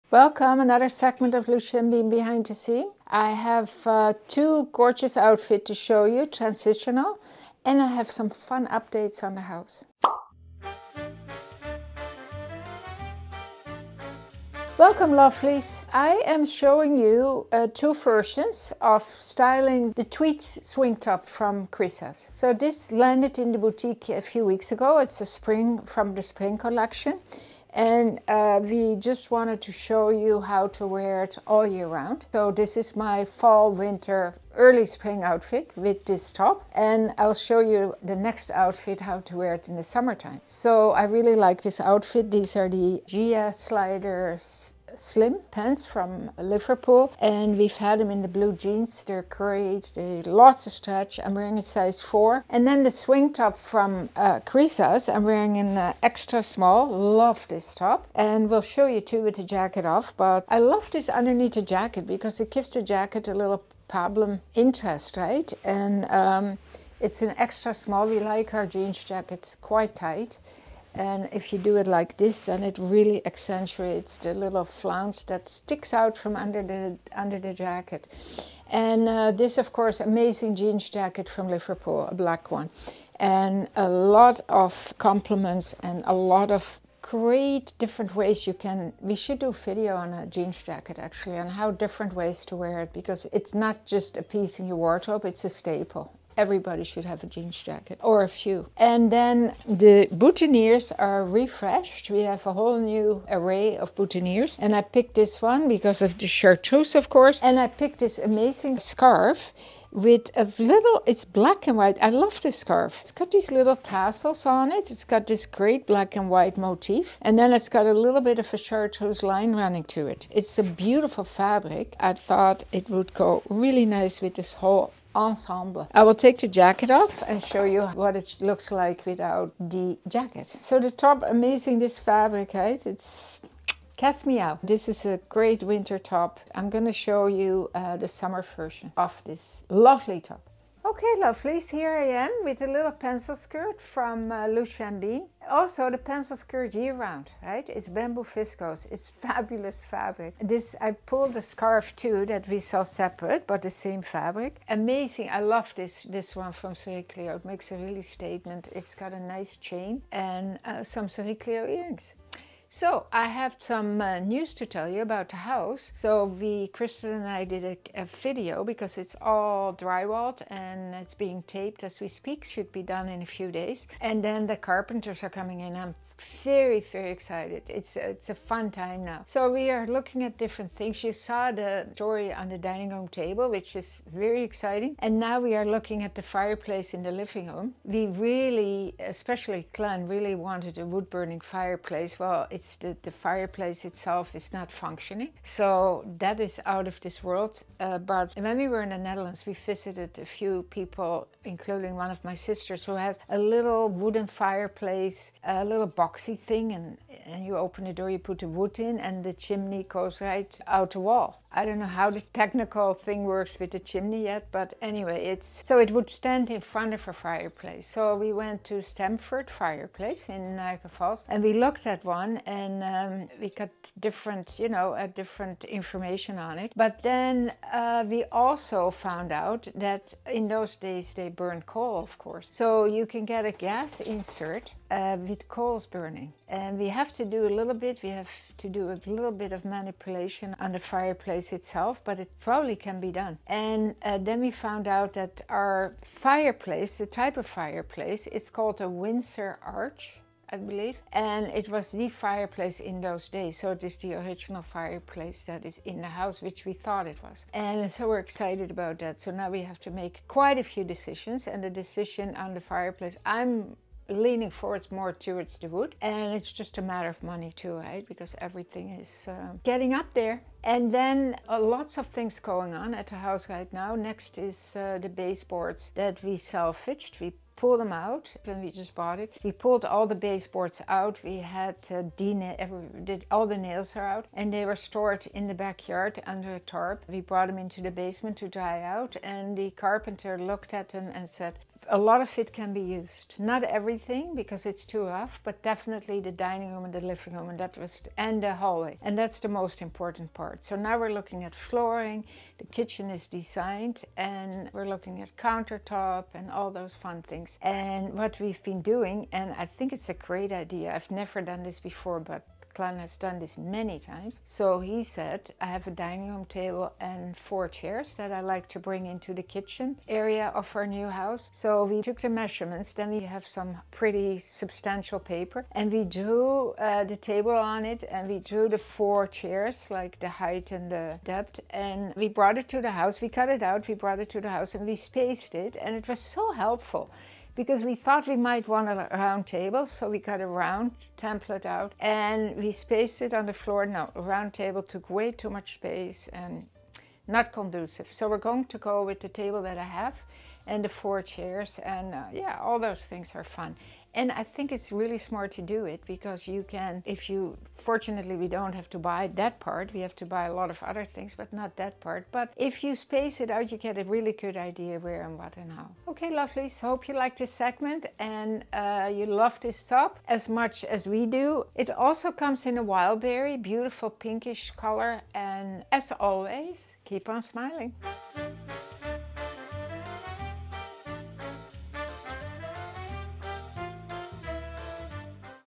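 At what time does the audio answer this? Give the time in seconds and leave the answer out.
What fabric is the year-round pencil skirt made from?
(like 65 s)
147 s.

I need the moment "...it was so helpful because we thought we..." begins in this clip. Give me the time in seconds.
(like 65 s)
335 s.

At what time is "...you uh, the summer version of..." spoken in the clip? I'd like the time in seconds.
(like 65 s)
137 s.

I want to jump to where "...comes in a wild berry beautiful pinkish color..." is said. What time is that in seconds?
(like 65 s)
372 s.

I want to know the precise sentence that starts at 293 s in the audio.
Not everything because it's too rough, but definitely the dining room and the living room and that was and the hallway.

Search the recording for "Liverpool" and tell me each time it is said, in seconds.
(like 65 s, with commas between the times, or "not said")
46 s, 81 s.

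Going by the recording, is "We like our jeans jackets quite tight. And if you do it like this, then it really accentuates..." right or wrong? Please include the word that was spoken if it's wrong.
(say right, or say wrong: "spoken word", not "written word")
right.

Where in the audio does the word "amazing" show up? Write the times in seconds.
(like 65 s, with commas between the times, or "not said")
79 s, 108 s, 131 s, 154 s.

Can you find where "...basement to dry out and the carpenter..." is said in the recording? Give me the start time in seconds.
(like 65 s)
287 s.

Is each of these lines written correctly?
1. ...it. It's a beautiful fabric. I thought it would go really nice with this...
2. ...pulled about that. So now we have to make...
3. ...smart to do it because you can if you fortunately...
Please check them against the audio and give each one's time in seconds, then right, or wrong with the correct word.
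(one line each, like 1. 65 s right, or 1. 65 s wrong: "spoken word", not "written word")
1. 120 s right
2. 258 s wrong: "excited", not "pulled"
3. 355 s right.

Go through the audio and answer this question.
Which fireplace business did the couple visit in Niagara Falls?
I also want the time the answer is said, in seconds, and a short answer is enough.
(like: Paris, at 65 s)
Stamford Fireplace, at 218 s.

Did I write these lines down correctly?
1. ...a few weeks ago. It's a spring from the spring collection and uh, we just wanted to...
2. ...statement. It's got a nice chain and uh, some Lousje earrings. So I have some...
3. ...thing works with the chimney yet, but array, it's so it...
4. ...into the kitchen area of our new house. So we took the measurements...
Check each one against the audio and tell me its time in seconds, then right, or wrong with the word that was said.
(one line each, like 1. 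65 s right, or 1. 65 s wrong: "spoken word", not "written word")
1. 24 s right
2. 158 s wrong: "Sericlio", not "Lousje"
3. 212 s wrong: "anyway", not "array"
4. 319 s right.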